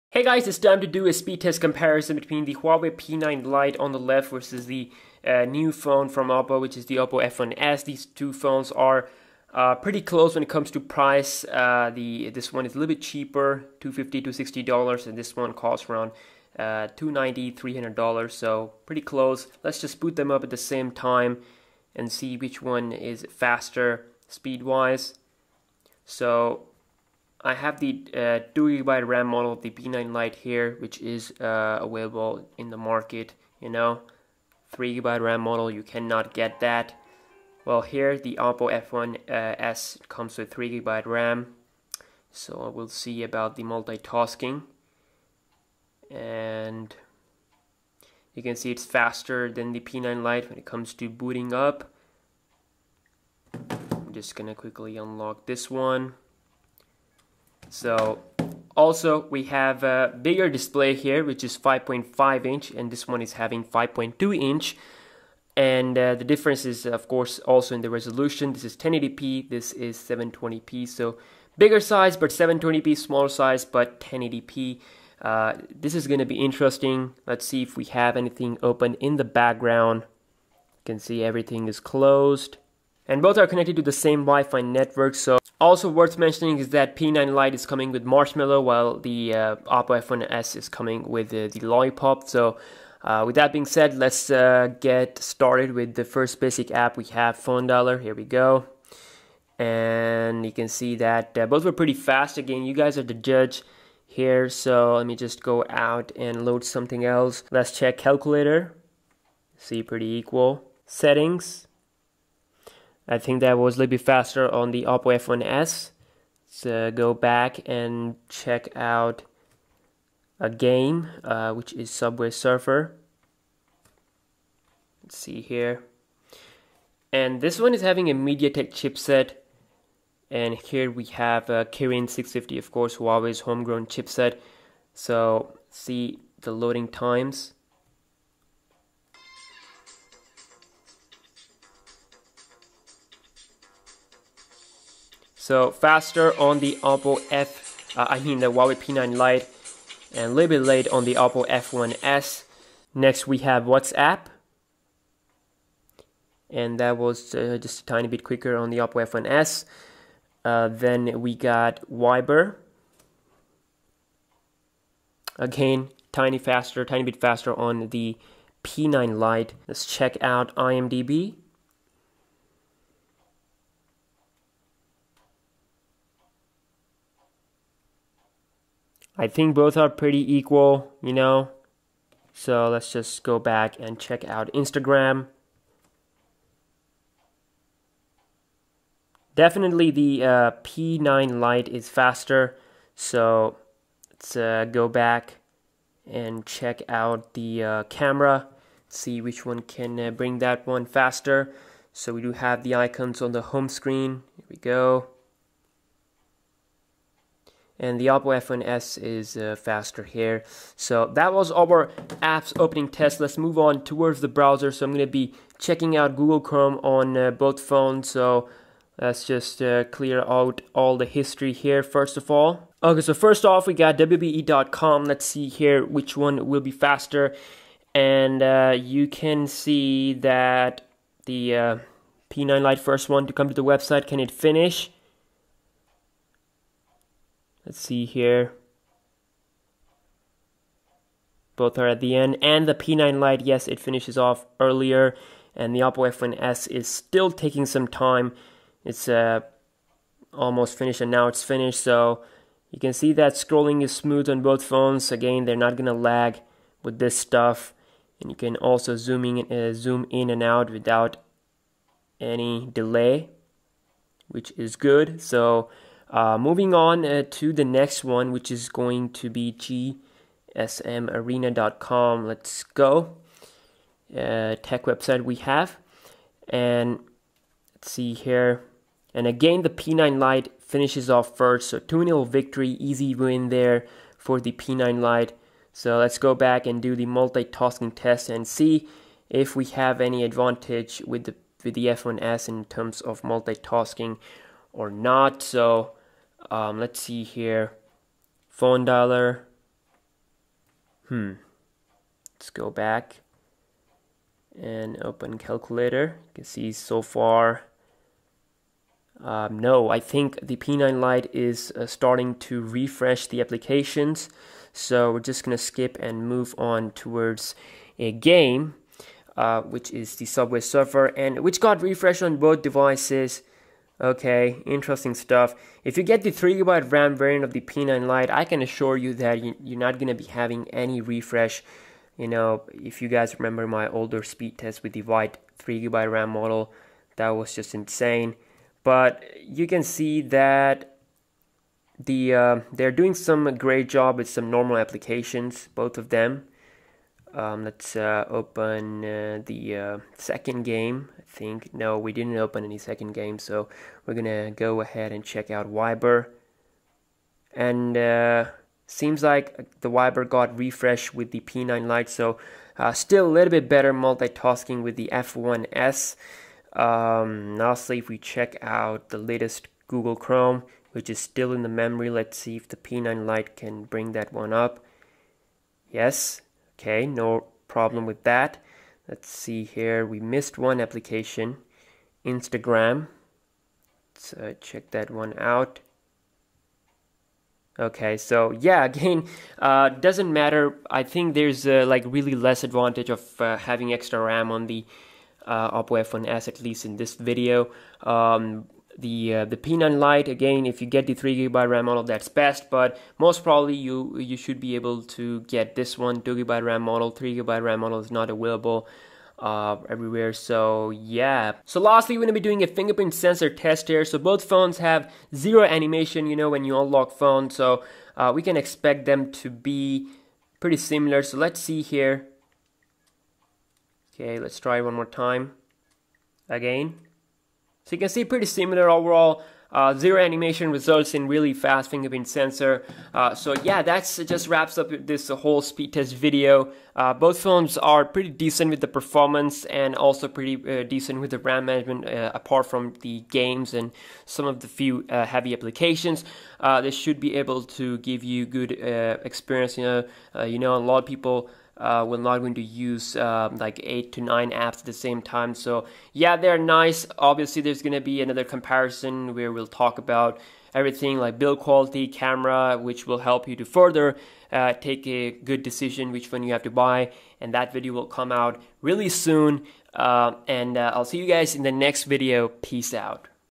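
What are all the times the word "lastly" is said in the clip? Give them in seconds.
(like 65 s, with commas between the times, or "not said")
367 s, 411 s.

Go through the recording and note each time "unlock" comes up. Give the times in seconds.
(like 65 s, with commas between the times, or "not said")
54 s, 416 s.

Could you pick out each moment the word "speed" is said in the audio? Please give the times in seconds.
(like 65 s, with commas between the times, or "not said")
1 s, 24 s, 334 s, 435 s.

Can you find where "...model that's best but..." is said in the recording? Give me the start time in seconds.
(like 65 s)
401 s.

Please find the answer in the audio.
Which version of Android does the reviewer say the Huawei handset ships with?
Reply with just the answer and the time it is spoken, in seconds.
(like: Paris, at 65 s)
Marshmallow, at 88 s.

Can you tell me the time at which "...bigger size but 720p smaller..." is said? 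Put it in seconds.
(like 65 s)
71 s.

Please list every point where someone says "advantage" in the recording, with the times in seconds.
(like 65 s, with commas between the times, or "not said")
290 s, 392 s.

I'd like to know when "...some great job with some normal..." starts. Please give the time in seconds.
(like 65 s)
343 s.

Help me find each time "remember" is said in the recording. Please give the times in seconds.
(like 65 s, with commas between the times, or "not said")
333 s.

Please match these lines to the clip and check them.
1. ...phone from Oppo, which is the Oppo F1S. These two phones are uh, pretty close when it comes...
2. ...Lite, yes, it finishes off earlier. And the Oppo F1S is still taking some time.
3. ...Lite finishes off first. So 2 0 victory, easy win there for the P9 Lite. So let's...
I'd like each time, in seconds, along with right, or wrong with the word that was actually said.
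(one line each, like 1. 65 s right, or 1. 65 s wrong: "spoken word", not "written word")
1. 5 s right
2. 243 s right
3. 280 s right.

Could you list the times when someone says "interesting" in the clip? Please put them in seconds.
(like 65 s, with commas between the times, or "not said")
76 s, 324 s.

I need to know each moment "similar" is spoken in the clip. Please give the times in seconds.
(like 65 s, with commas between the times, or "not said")
420 s, 428 s.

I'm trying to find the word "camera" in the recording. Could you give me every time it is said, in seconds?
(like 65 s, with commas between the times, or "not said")
197 s, 462 s.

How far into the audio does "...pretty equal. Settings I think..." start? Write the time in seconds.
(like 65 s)
109 s.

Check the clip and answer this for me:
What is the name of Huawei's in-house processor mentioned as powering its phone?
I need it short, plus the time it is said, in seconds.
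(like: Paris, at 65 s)
Kirin 650, at 131 s.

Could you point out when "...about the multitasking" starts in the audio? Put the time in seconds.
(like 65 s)
43 s.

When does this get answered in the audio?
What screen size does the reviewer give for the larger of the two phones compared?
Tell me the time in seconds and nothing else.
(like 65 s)
61 s.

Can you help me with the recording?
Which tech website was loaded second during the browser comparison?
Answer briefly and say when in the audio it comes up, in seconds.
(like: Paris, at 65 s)
gsmarena.com, at 270 s.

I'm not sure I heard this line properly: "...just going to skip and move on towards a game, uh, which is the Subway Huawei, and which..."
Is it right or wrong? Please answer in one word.
wrong.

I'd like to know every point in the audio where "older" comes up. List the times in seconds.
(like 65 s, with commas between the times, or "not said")
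333 s.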